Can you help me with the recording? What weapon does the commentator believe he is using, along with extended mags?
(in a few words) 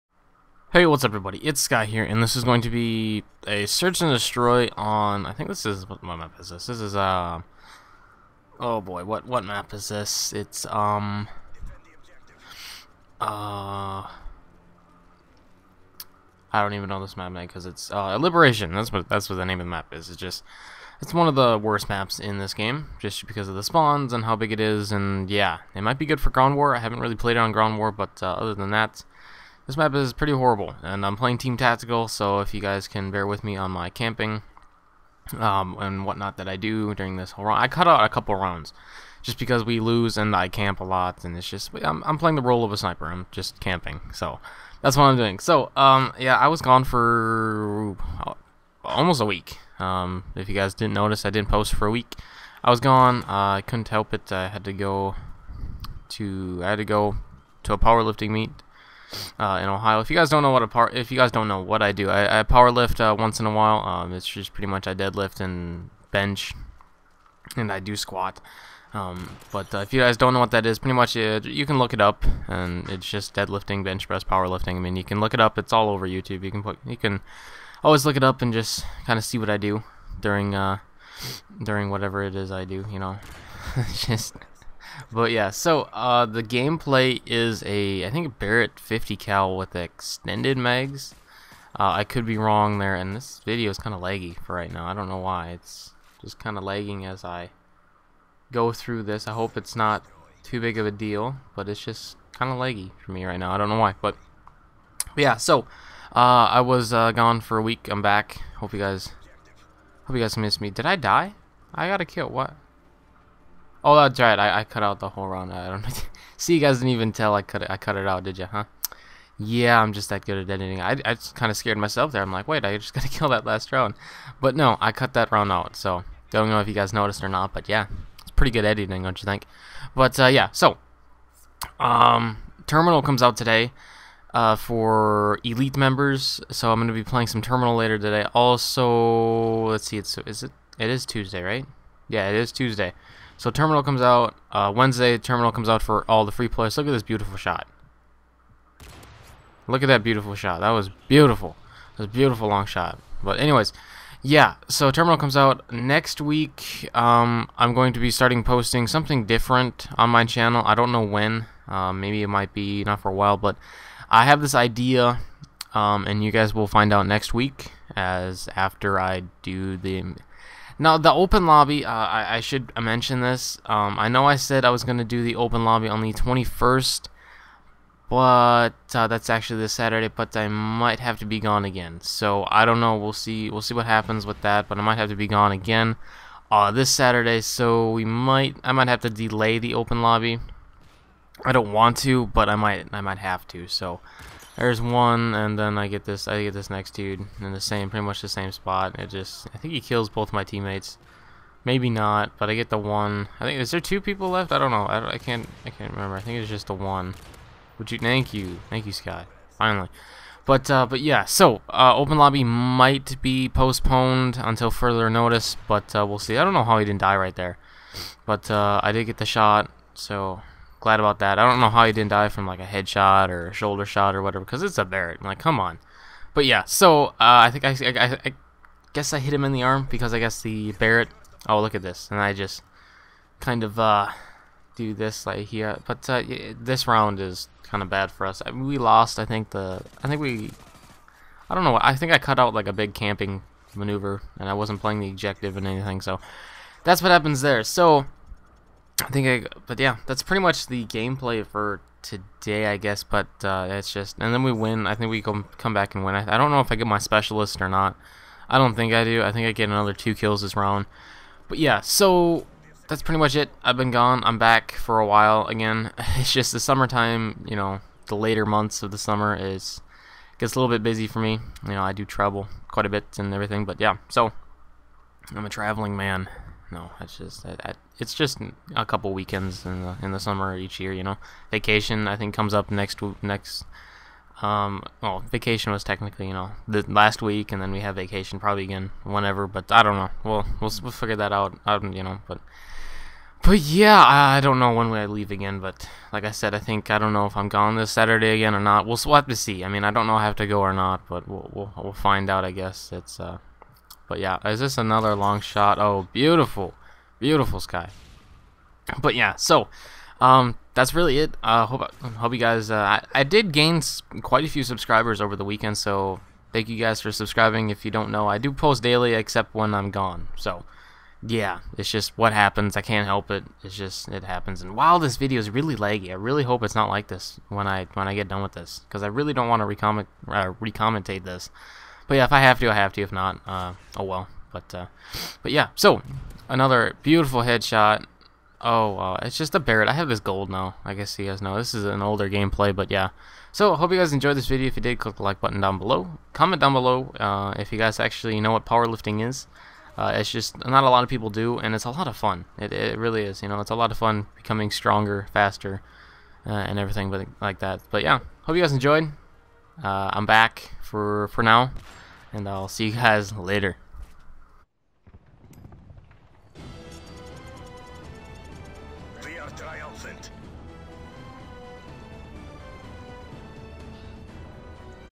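Barrett 50 cal.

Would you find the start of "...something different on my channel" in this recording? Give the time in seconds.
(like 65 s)
158 s.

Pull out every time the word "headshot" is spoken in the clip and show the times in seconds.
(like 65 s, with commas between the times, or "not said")
222 s, 337 s.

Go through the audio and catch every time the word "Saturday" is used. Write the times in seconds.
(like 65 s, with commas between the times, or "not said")
179 s, 186 s, 297 s.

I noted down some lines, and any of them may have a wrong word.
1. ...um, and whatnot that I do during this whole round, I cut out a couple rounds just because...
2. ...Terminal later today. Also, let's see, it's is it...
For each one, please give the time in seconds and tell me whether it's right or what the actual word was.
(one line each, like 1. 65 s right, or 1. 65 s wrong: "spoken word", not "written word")
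1. 35 s right
2. 137 s right.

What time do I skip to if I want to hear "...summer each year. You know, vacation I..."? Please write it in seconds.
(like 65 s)
280 s.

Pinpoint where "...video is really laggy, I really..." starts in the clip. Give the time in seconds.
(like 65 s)
325 s.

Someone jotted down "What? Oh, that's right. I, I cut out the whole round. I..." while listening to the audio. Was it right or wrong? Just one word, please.
right.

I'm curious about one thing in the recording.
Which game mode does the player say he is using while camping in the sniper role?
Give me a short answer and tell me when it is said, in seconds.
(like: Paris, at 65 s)
Team Tactical, at 31 s.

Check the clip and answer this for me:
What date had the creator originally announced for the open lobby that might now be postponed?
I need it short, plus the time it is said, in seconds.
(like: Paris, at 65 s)
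21st, at 176 s.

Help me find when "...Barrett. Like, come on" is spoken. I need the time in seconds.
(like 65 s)
224 s.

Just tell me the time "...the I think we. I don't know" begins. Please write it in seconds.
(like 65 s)
239 s.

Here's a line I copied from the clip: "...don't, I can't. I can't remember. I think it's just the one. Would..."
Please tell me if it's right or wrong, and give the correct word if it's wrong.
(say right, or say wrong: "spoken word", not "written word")
right.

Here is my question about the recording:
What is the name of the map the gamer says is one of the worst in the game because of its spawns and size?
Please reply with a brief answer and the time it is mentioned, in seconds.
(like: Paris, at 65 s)
Liberation, at 18 s.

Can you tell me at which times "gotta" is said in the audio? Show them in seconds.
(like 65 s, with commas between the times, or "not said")
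122 s.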